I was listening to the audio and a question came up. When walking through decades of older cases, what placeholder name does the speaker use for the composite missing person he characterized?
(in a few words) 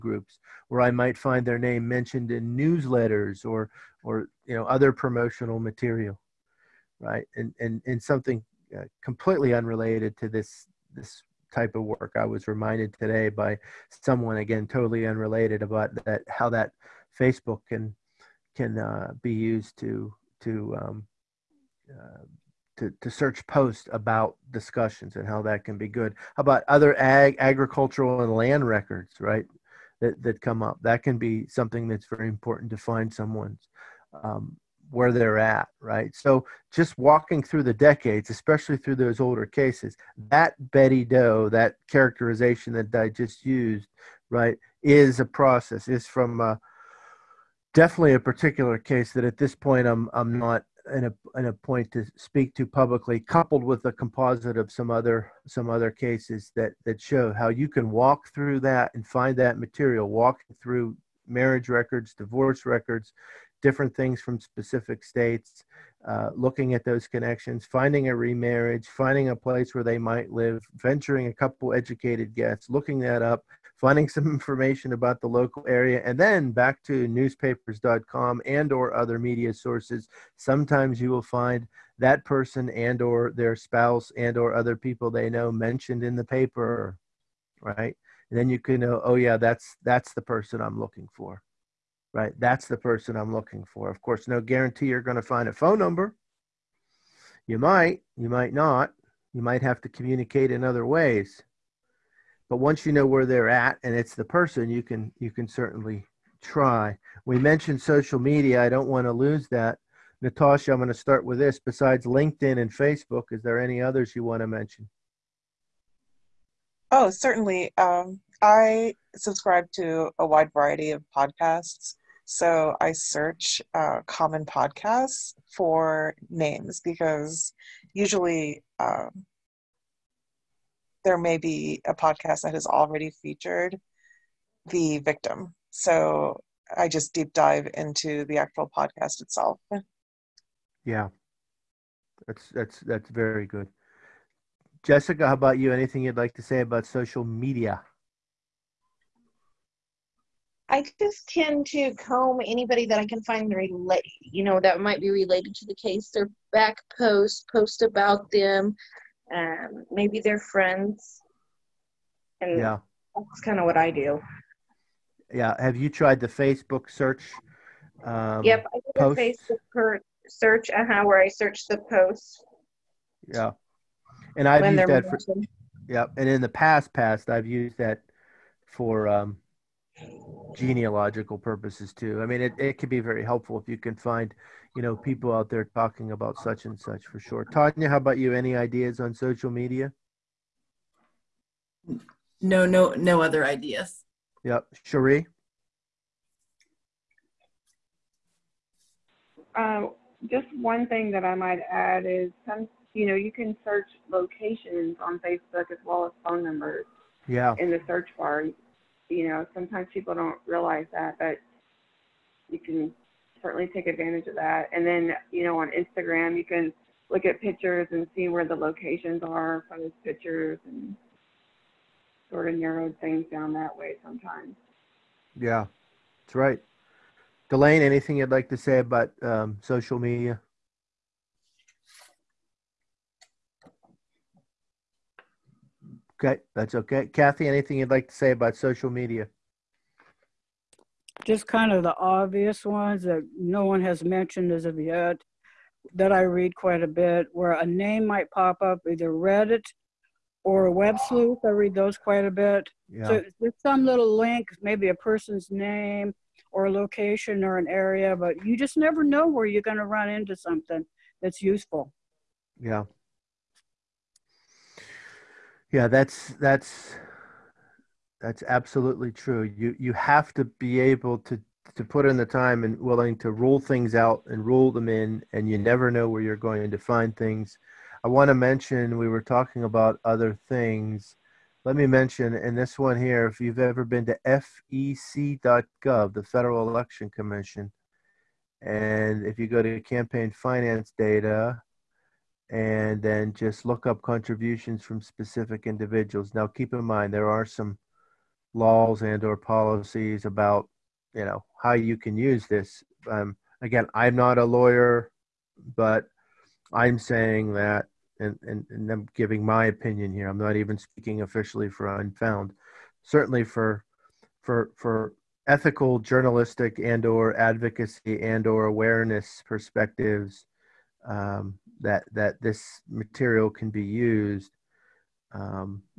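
Betty Doe.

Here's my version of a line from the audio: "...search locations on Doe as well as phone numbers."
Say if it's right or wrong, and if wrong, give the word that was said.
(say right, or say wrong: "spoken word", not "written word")
wrong: "Facebook", not "Doe".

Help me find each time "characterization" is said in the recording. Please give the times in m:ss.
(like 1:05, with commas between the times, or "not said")
0:41.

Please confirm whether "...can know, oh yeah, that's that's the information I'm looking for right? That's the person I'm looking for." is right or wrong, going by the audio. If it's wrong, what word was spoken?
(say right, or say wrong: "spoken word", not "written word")
wrong: "person", not "information".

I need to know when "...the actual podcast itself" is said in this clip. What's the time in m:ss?
2:18.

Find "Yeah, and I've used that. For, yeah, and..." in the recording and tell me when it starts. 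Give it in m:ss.
2:53.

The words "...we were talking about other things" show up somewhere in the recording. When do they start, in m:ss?
4:38.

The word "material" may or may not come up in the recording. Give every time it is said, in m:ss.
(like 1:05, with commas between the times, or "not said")
0:05, 0:59, 5:22.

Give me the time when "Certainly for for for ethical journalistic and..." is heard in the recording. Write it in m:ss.
5:13.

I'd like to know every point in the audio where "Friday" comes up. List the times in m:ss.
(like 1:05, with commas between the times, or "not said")
not said.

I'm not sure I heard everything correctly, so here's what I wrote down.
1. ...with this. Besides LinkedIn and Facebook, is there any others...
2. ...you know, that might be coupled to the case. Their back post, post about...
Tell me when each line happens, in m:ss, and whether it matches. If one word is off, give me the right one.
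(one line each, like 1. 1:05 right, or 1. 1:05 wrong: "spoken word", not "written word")
1. 1:51 right
2. 2:34 wrong: "related", not "coupled".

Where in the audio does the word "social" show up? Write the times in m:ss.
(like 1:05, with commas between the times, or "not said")
1:47, 2:26, 3:09, 3:49, 3:58.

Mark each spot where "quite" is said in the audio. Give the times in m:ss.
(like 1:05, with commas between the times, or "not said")
4:06, 4:11.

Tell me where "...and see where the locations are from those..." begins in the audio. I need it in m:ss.
3:37.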